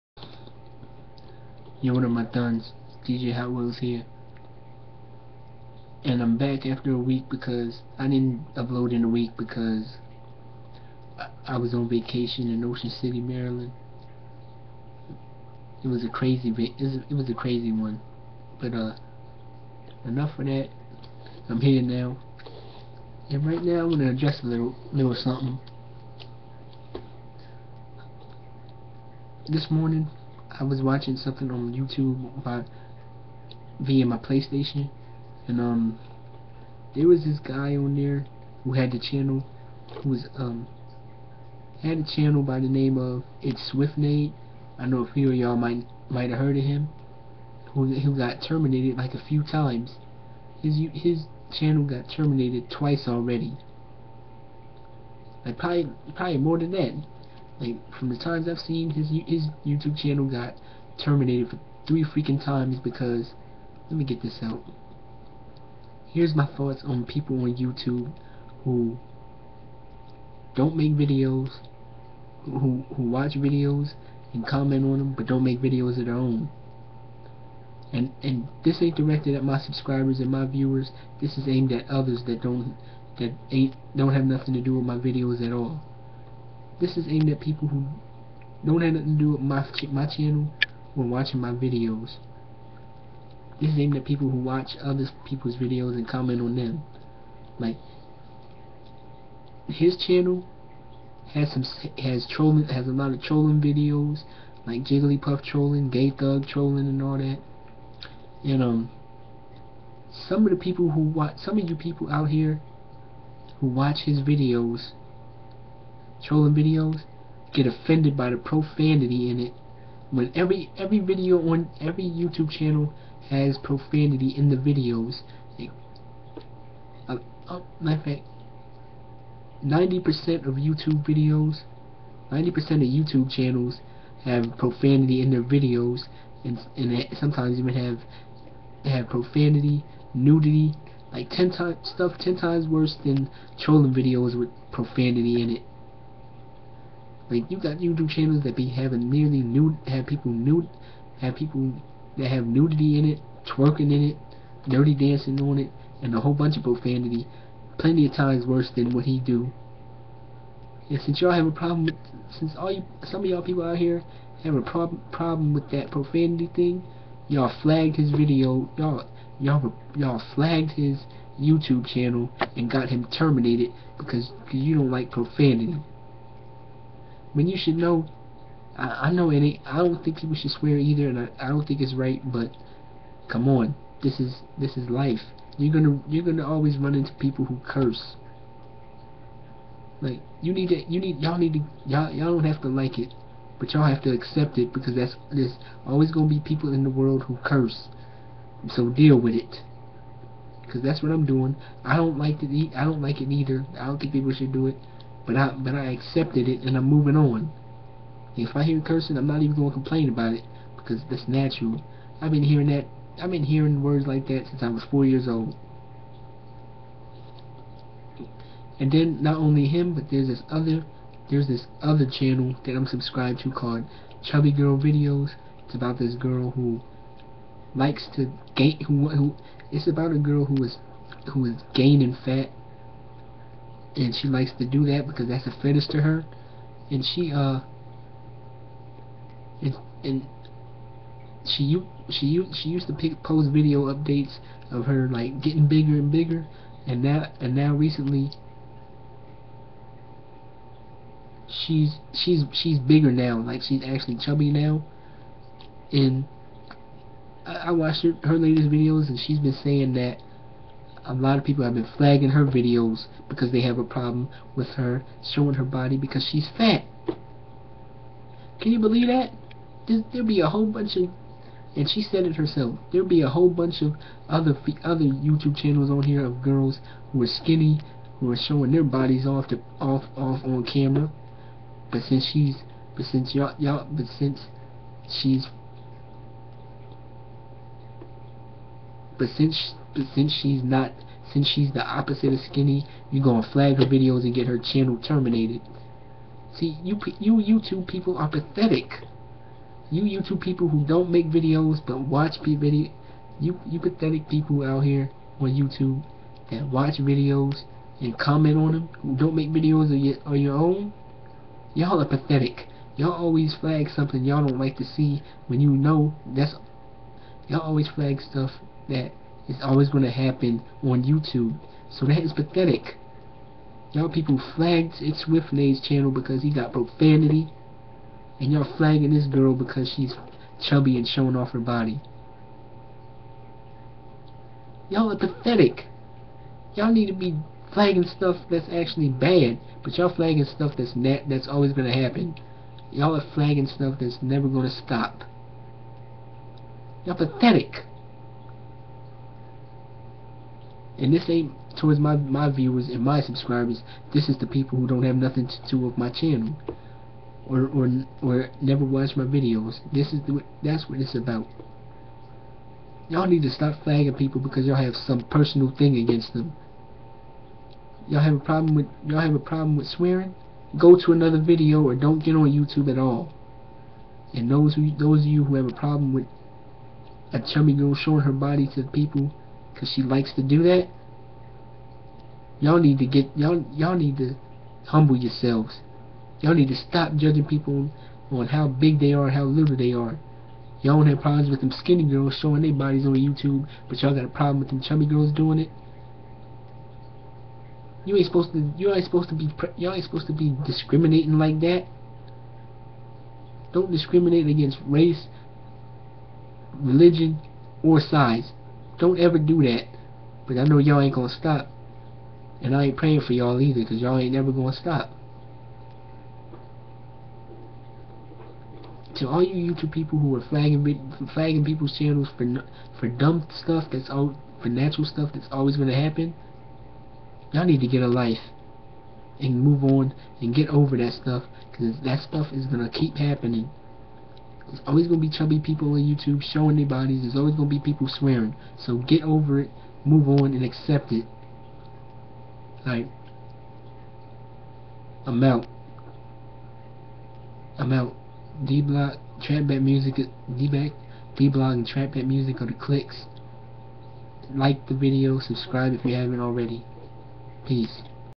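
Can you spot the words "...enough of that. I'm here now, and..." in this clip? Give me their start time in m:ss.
0:20.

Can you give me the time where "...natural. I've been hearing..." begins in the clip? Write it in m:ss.
3:31.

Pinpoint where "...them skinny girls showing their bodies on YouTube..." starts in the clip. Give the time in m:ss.
6:31.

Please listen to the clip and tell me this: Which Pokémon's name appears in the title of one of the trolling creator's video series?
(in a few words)
Jigglypuff.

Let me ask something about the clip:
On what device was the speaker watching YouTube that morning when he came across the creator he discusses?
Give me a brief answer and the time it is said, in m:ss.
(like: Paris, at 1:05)
PlayStation, at 0:34.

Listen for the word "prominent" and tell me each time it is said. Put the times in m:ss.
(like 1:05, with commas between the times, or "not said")
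not said.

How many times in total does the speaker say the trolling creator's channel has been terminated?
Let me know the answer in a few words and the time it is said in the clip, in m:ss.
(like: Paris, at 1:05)
3, at 1:01.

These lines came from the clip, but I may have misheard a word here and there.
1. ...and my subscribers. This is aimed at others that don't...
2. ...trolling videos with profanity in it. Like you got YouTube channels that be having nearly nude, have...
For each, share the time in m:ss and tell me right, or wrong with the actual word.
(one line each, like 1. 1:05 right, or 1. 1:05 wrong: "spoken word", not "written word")
1. 1:20 wrong: "viewers", not "subscribers"
2. 2:23 right.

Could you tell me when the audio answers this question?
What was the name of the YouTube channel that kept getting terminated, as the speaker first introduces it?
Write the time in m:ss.
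0:43.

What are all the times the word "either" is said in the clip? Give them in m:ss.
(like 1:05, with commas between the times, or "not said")
3:00, 3:23, 6:53.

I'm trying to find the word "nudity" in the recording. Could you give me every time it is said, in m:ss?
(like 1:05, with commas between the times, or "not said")
2:20, 2:32.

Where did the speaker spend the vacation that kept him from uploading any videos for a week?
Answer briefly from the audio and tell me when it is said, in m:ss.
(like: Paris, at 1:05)
Ocean City, Maryland, at 0:12.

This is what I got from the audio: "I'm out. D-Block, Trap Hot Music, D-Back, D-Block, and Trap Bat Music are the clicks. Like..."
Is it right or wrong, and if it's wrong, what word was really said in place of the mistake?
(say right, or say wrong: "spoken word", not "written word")
wrong: "Bat", not "Hot".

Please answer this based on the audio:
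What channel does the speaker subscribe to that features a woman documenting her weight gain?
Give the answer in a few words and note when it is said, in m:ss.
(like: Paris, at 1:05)
Chubby Girl Videos, at 3:44.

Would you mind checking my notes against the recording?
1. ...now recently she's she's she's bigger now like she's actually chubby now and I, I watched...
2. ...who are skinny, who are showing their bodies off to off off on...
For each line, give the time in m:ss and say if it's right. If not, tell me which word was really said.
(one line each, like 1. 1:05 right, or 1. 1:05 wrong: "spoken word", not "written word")
1. 4:07 right
2. 4:37 right.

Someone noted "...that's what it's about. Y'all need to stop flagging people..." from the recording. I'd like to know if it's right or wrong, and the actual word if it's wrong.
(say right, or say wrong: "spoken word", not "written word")
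right.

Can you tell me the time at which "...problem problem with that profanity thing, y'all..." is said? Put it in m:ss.
2:44.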